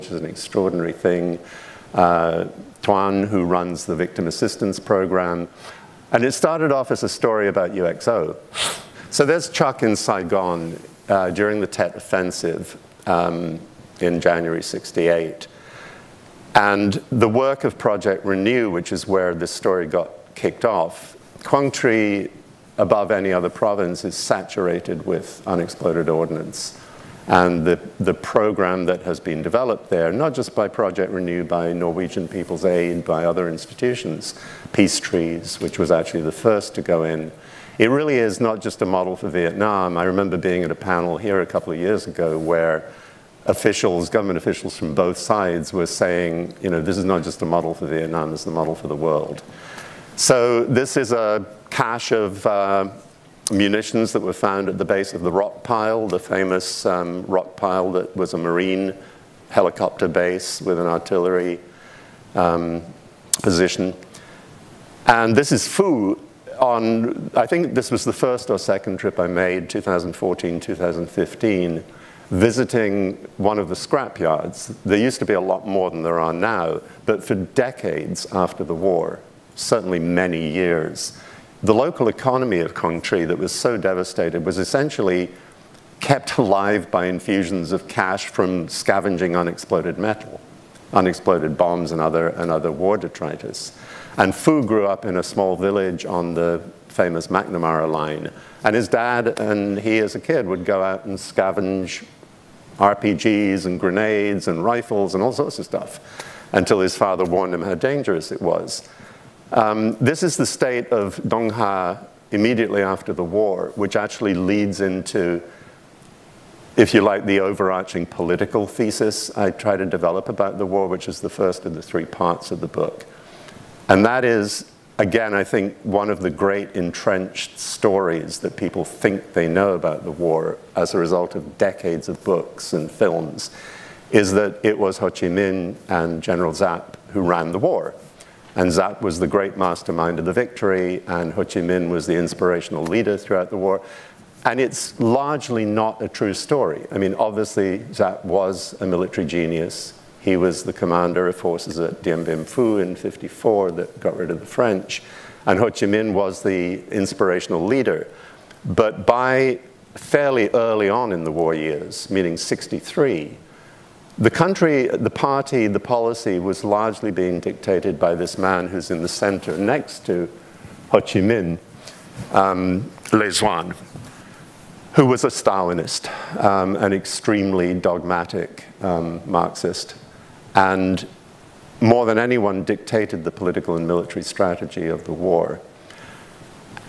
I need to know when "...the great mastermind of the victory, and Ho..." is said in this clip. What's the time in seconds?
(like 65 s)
139 s.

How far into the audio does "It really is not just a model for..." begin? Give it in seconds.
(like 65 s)
37 s.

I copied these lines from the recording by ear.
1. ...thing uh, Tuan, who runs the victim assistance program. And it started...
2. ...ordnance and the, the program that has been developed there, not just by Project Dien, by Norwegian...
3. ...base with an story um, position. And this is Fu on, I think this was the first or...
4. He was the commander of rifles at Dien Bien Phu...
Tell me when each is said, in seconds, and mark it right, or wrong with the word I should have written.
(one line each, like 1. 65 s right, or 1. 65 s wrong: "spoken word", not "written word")
1. 0 s right
2. 26 s wrong: "Renew", not "Dien"
3. 60 s wrong: "artillery", not "story"
4. 150 s wrong: "forces", not "rifles".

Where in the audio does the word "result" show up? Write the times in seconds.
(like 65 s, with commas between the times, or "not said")
130 s.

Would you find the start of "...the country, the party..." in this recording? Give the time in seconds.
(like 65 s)
164 s.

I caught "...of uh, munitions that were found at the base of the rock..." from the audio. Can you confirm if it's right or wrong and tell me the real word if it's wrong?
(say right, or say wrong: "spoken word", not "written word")
right.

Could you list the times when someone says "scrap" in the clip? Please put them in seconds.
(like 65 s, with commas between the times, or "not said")
73 s.